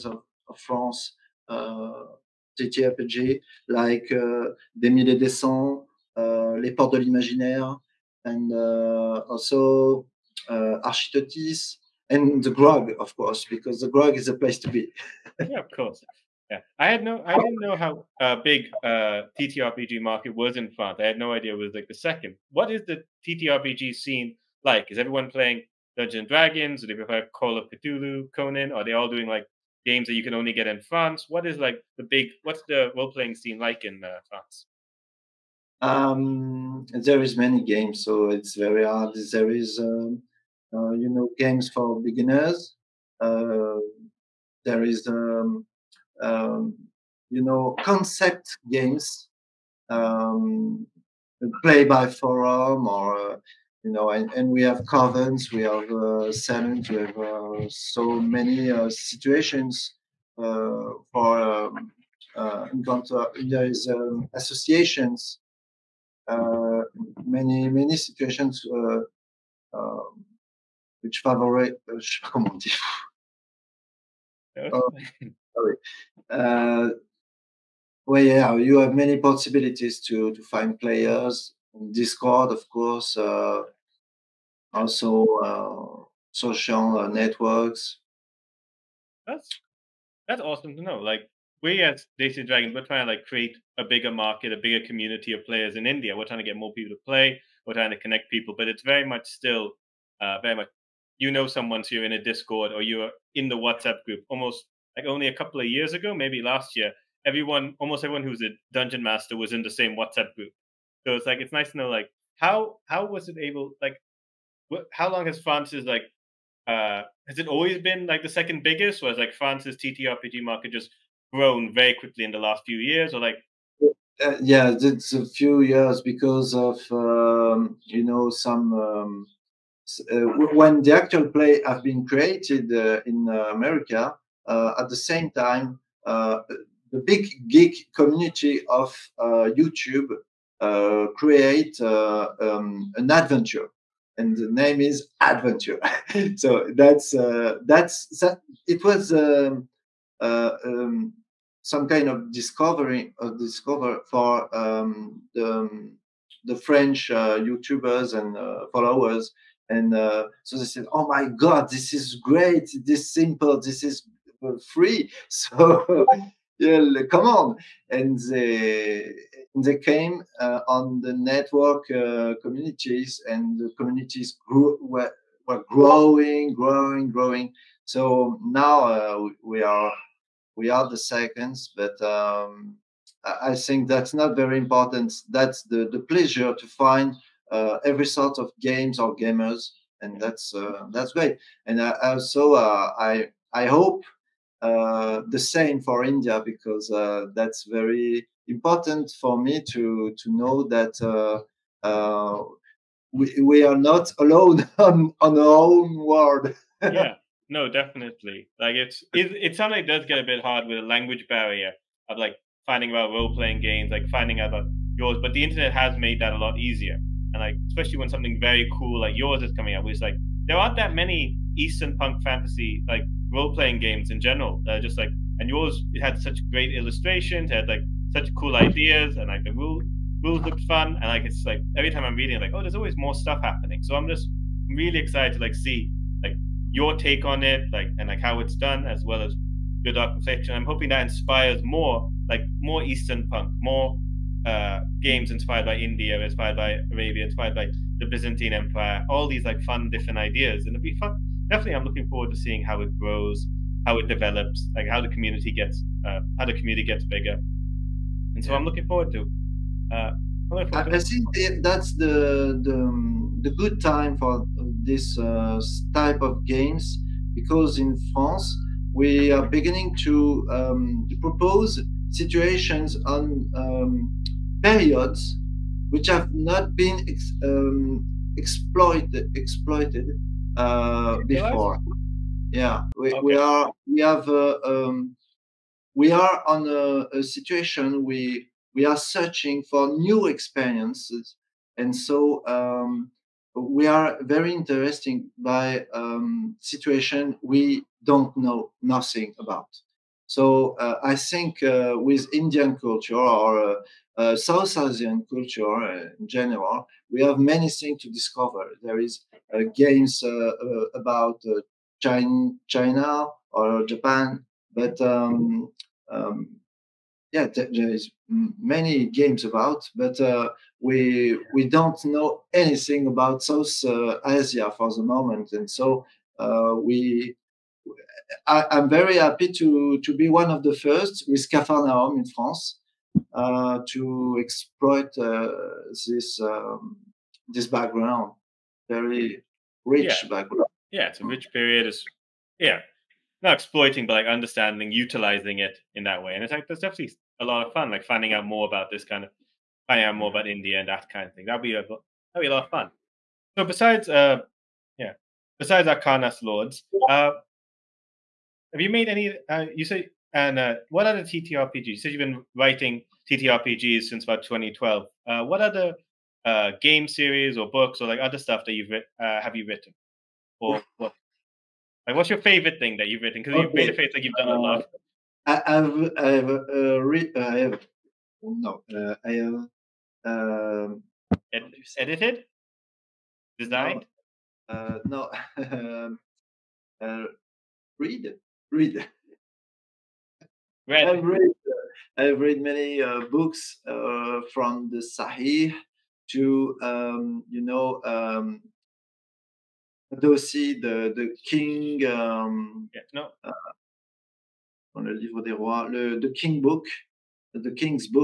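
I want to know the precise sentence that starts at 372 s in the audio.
Like, what's your favorite thing that you've written?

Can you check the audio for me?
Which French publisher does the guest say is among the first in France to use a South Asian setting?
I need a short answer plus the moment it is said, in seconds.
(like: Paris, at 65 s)
Capharnaüm, at 331 s.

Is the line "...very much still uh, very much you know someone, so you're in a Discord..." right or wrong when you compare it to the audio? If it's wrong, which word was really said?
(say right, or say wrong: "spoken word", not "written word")
right.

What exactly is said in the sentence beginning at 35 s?
Um, there is many games, so it's very hard.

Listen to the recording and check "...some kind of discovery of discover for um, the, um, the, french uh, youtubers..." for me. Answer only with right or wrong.
right.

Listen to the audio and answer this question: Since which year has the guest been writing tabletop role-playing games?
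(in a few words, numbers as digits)
2012.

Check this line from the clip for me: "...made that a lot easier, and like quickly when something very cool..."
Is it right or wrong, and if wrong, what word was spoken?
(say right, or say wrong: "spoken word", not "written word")
wrong: "especially", not "quickly".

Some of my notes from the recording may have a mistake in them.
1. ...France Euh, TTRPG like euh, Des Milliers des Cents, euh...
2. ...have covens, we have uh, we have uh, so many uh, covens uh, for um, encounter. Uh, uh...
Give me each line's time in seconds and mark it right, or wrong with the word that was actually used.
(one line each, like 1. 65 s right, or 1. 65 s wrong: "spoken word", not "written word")
1. 0 s right
2. 54 s wrong: "situations", not "covens".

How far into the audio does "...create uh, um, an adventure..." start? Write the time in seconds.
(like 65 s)
141 s.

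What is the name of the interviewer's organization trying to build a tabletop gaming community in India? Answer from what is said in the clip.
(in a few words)
Desis Dragons.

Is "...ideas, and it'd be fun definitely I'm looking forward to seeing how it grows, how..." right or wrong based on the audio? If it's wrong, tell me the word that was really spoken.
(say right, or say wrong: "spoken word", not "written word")
right.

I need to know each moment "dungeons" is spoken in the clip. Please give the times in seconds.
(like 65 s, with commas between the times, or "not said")
25 s, 108 s.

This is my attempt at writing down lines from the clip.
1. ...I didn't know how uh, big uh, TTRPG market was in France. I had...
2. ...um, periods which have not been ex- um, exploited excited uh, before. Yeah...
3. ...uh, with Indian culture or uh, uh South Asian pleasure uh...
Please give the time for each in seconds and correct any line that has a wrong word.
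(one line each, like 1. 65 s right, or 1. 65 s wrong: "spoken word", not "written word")
1. 17 s right
2. 273 s wrong: "exploited", not "excited"
3. 301 s wrong: "culture", not "pleasure".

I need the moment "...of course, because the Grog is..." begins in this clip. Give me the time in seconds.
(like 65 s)
12 s.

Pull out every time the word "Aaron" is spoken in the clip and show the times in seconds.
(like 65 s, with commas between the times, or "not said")
not said.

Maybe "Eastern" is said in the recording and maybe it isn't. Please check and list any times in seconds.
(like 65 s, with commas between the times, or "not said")
221 s, 242 s.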